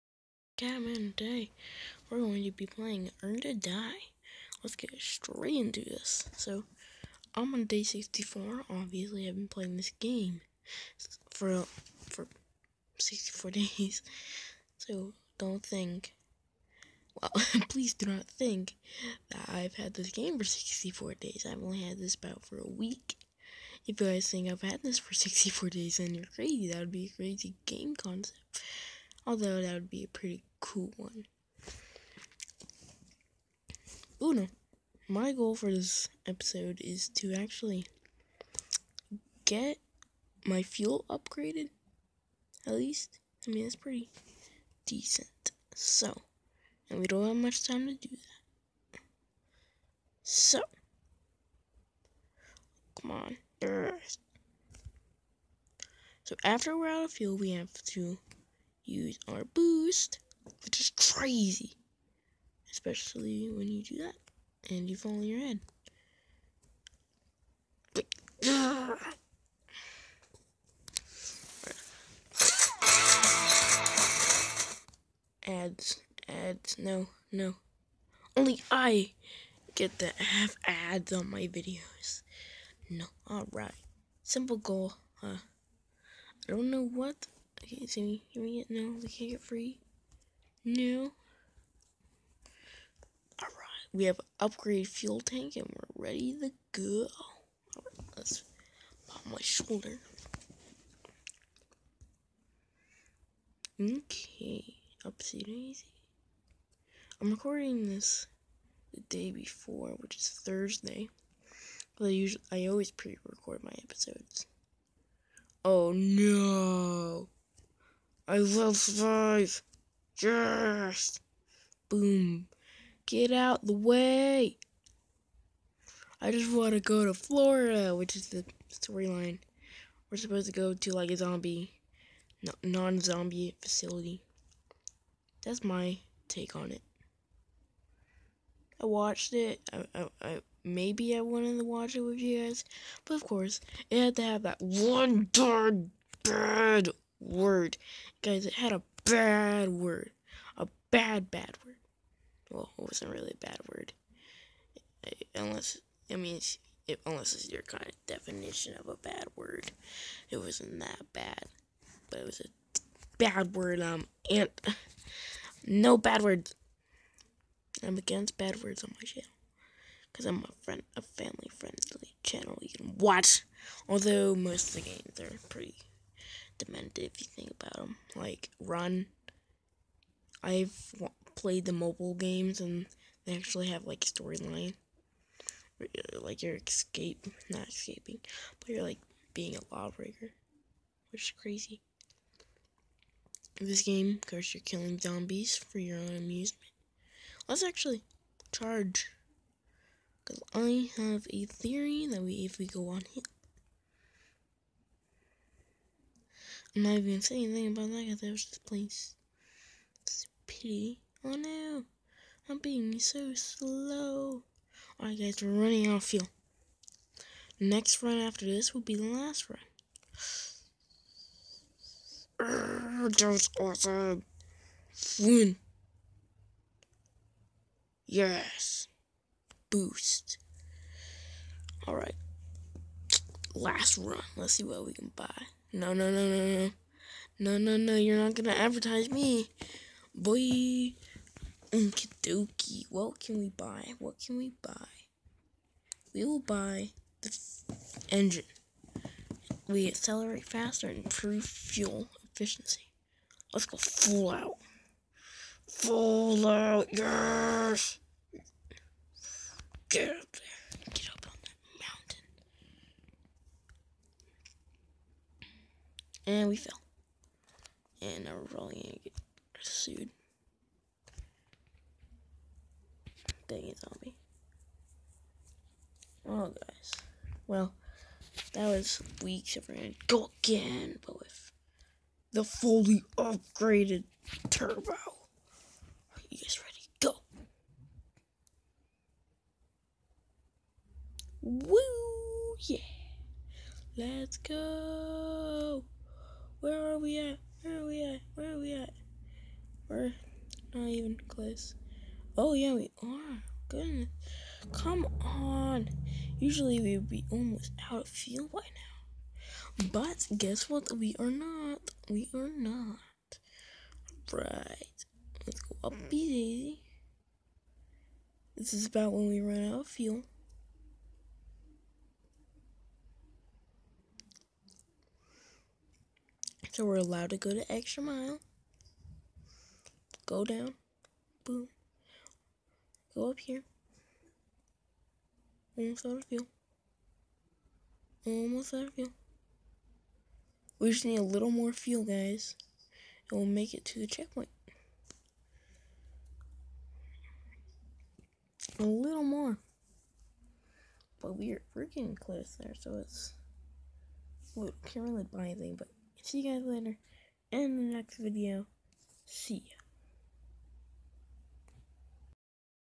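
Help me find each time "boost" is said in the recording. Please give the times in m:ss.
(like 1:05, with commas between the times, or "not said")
0:59, 3:49.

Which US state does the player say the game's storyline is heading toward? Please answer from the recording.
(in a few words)
Florida.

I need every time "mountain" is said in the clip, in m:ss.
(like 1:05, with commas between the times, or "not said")
4:21.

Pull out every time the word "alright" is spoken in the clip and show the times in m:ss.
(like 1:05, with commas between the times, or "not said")
1:23, 1:33, 3:34, 3:51.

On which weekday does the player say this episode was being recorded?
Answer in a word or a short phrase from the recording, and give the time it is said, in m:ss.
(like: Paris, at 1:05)
Thursday, at 1:50.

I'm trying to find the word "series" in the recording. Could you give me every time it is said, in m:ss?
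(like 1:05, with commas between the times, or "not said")
not said.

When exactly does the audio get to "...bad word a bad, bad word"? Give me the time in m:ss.
2:29.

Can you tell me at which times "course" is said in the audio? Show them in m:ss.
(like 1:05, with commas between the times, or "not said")
2:23, 3:14.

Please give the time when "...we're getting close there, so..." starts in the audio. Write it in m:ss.
5:51.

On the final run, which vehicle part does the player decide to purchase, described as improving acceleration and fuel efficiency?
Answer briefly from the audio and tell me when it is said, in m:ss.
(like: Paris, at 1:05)
engine, at 4:08.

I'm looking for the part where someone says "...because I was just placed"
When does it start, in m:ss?
3:28.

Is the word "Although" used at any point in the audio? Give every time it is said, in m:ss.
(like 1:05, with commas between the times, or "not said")
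0:29, 2:53.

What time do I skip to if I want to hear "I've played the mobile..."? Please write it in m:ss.
3:00.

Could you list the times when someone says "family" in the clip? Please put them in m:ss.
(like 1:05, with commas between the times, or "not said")
2:51.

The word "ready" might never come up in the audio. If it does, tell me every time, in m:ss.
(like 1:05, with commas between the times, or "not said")
1:36, 4:46.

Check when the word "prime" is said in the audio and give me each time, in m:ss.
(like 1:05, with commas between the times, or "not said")
not said.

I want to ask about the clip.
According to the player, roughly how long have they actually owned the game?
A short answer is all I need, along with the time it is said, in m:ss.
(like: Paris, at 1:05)
a week, at 0:22.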